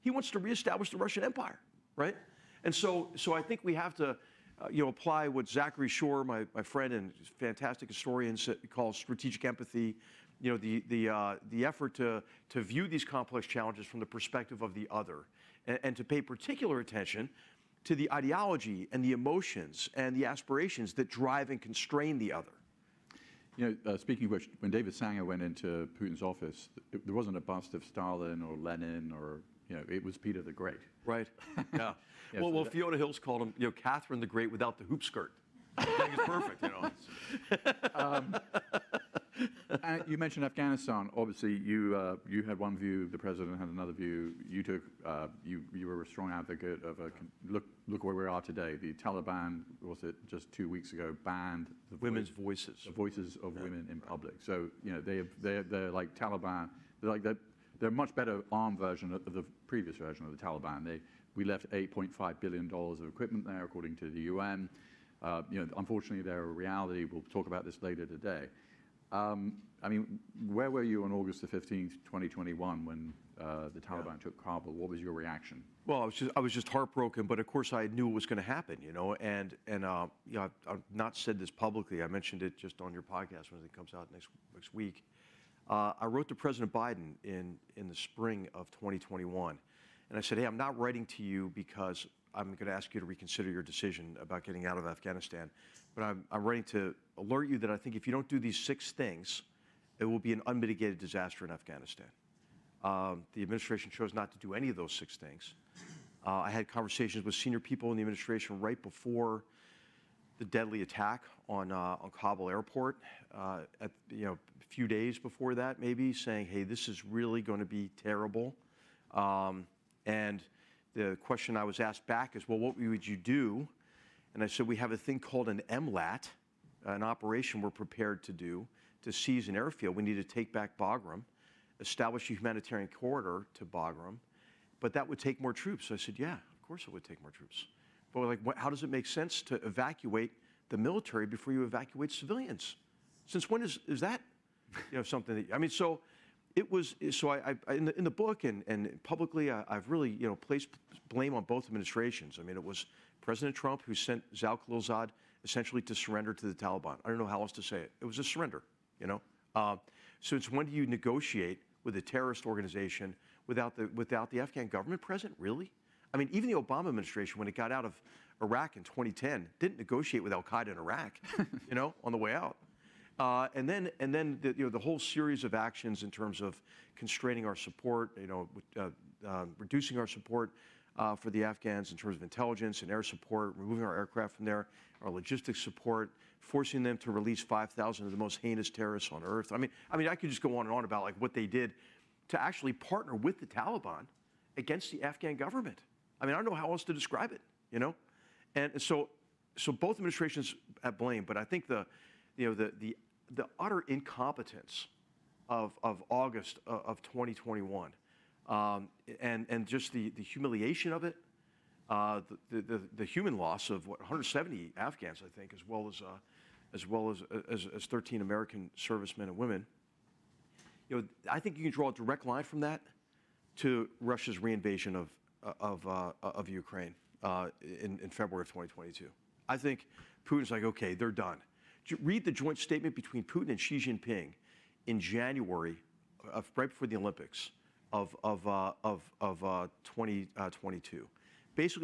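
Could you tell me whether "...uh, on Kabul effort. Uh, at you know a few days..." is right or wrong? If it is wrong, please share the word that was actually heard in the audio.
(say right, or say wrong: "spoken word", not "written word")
wrong: "airport", not "effort".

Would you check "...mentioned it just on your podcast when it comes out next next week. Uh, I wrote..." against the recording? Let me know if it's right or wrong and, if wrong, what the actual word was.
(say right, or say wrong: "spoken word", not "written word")
right.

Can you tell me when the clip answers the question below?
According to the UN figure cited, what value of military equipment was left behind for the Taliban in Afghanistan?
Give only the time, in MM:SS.
01:01.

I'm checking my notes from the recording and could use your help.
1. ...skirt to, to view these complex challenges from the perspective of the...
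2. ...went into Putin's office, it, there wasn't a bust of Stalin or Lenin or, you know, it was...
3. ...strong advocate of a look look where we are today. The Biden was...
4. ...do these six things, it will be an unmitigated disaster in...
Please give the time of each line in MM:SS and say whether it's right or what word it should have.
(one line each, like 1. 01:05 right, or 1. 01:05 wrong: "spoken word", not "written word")
1. 00:11 wrong: "effort", not "skirt"
2. 00:25 right
3. 00:46 wrong: "Taliban", not "Biden"
4. 01:38 right.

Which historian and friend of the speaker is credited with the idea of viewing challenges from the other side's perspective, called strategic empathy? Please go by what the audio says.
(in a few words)
Zachary Shore.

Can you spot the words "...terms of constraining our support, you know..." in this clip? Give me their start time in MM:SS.
02:56.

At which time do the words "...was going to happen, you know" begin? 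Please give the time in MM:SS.
01:18.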